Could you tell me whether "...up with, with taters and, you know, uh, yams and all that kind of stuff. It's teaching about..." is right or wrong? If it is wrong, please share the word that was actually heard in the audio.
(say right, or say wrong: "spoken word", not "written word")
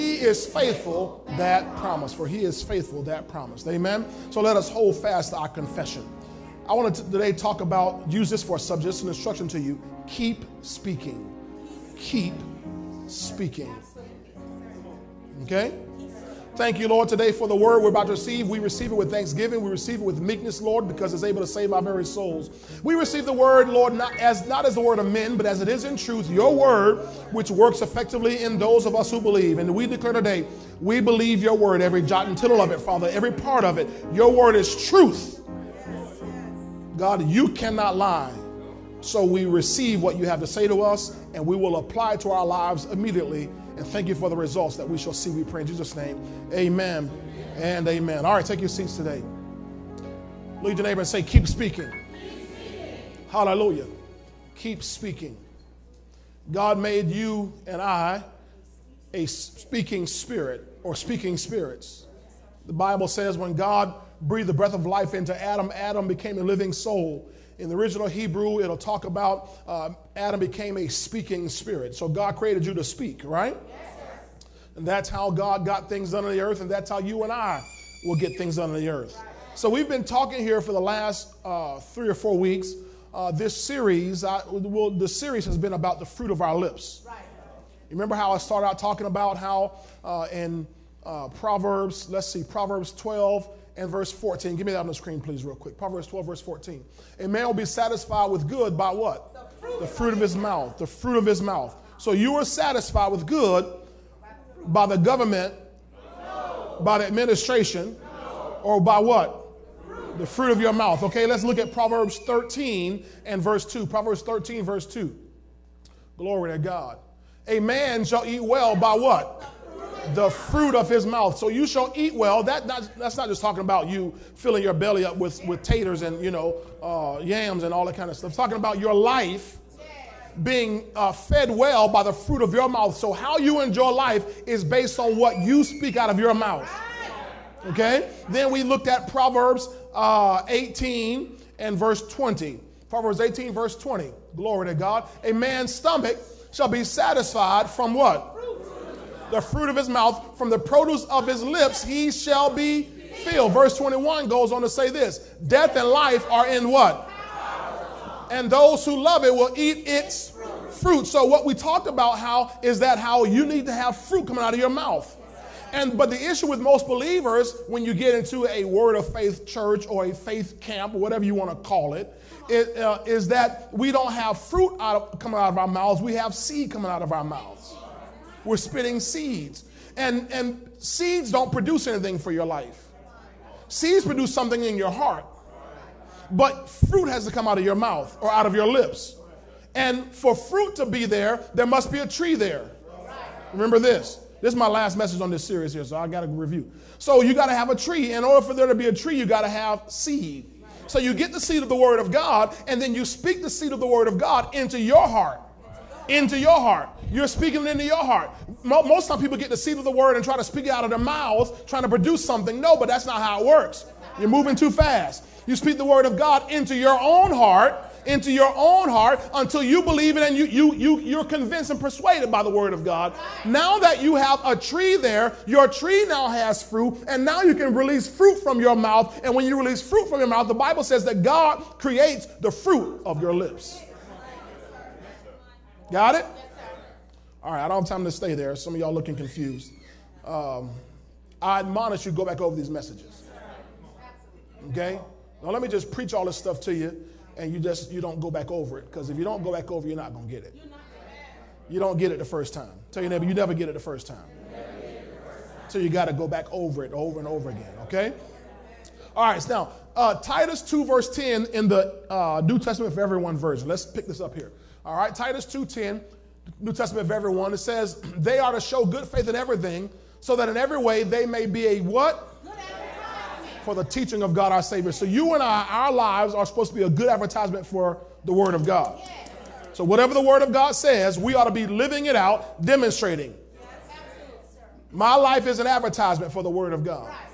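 wrong: "talking", not "teaching".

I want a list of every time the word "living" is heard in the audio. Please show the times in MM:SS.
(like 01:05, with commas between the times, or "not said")
01:06, 04:41.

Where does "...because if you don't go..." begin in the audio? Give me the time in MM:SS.
04:08.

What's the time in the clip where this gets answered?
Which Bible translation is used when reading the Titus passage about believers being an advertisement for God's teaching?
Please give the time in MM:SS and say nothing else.
04:22.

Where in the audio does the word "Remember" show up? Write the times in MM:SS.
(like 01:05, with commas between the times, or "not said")
01:27, 03:13.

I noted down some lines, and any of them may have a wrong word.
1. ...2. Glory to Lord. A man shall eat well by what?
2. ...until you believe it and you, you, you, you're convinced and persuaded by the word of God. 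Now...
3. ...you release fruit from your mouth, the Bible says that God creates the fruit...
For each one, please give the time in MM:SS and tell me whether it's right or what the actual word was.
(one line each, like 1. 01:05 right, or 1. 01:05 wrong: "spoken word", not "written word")
1. 01:54 wrong: "God", not "Lord"
2. 03:39 right
3. 03:49 right.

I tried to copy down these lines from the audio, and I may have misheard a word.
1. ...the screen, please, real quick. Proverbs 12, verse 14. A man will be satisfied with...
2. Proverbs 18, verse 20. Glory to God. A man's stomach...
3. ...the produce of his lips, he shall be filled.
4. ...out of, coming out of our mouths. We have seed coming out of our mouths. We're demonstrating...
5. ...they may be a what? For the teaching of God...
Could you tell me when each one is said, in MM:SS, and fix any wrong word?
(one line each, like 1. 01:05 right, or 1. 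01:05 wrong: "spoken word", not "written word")
1. 01:34 right
2. 02:22 right
3. 02:30 right
4. 02:54 wrong: "spitting", not "demonstrating"
5. 04:31 right.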